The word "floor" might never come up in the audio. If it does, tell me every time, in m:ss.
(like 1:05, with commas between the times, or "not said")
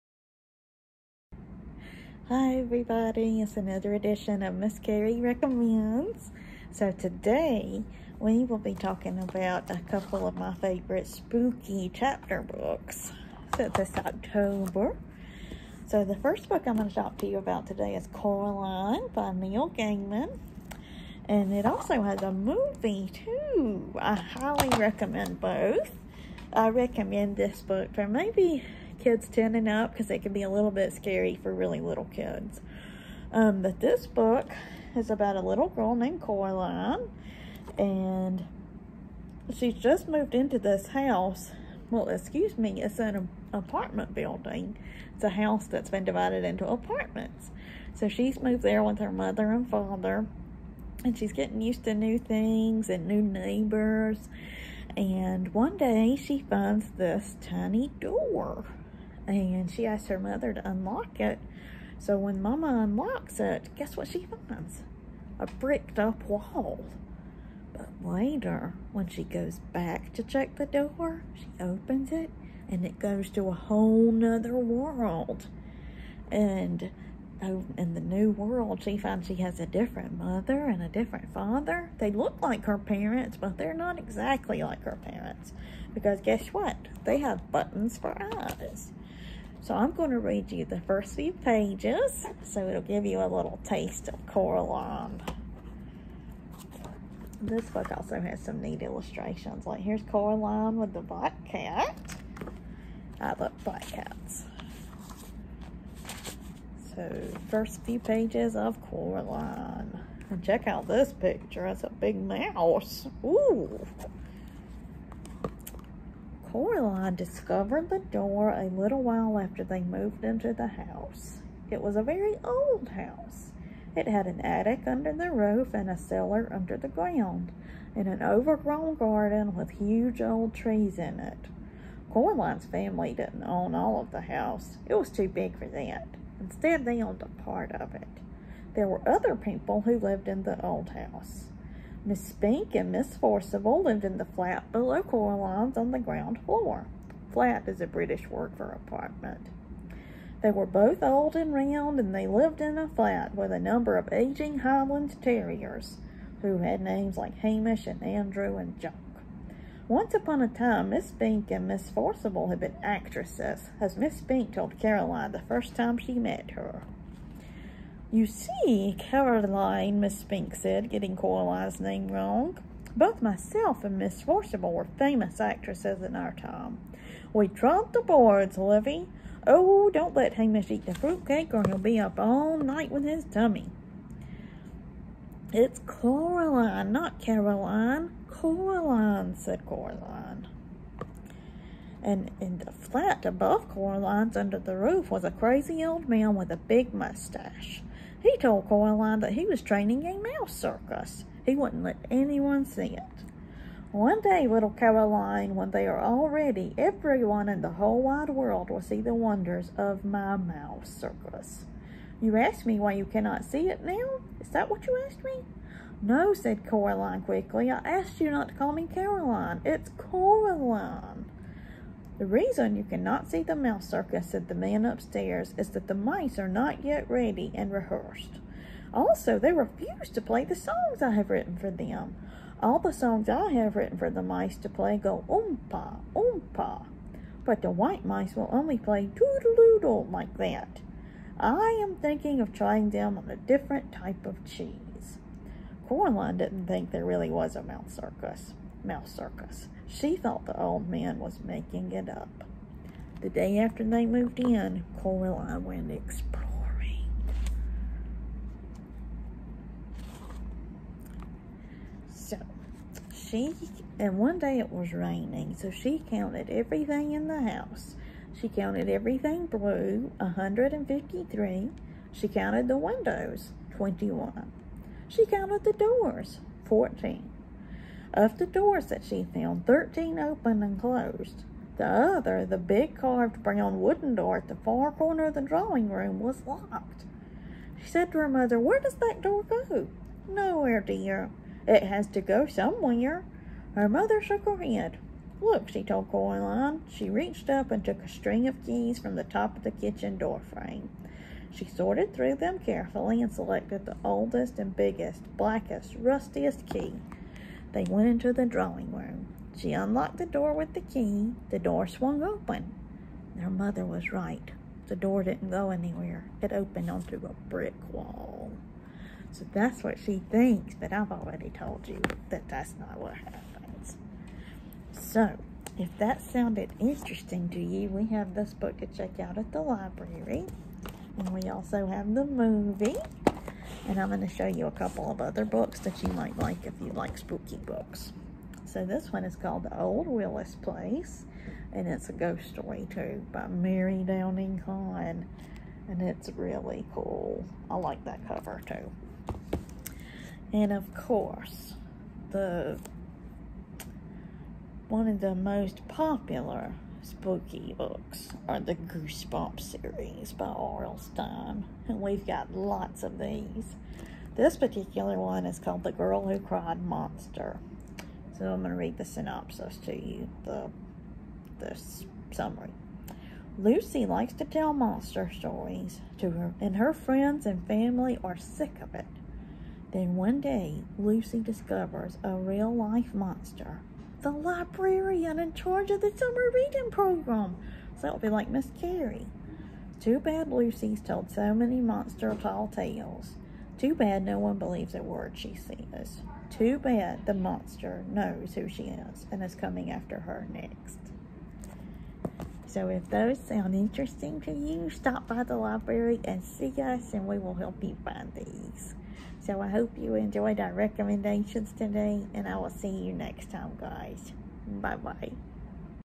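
2:26.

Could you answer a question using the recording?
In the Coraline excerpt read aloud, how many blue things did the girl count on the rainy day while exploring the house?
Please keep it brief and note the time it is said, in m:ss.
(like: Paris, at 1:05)
153, at 4:30.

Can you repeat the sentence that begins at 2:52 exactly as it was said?
Both myself and Miss Forcible were famous actresses in our time.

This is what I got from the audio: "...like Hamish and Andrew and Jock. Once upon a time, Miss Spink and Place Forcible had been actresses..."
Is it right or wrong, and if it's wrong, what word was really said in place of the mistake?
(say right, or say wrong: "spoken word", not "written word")
wrong: "Miss", not "Place".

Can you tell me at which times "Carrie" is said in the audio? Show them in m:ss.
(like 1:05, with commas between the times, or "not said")
0:04, 6:28.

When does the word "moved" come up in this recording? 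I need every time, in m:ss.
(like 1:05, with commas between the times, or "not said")
0:40, 0:48, 1:59, 4:14.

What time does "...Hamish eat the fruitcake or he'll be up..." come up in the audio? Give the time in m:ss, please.
3:00.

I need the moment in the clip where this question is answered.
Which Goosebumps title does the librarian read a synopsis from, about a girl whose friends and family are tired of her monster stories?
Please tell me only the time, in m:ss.
6:05.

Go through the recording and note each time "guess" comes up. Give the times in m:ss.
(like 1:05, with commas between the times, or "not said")
1:03, 1:26.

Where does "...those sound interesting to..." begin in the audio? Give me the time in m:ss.
6:43.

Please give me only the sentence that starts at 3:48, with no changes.
Also, they refuse to play the songs I have written for them.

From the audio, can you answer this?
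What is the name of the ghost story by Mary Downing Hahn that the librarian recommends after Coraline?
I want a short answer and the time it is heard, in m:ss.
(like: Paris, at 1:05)
The Old Willis Place, at 5:39.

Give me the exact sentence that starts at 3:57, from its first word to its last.
But the white mice will only play doodle, doodle like that.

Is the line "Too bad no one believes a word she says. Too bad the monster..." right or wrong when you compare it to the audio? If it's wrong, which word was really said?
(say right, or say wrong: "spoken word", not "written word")
right.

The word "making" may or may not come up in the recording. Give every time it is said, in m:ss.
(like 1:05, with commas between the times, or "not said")
4:11.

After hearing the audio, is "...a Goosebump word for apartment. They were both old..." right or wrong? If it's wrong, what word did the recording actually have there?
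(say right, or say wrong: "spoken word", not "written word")
wrong: "British", not "Goosebump".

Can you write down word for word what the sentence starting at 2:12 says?
Coraline's family didn't own all of the house.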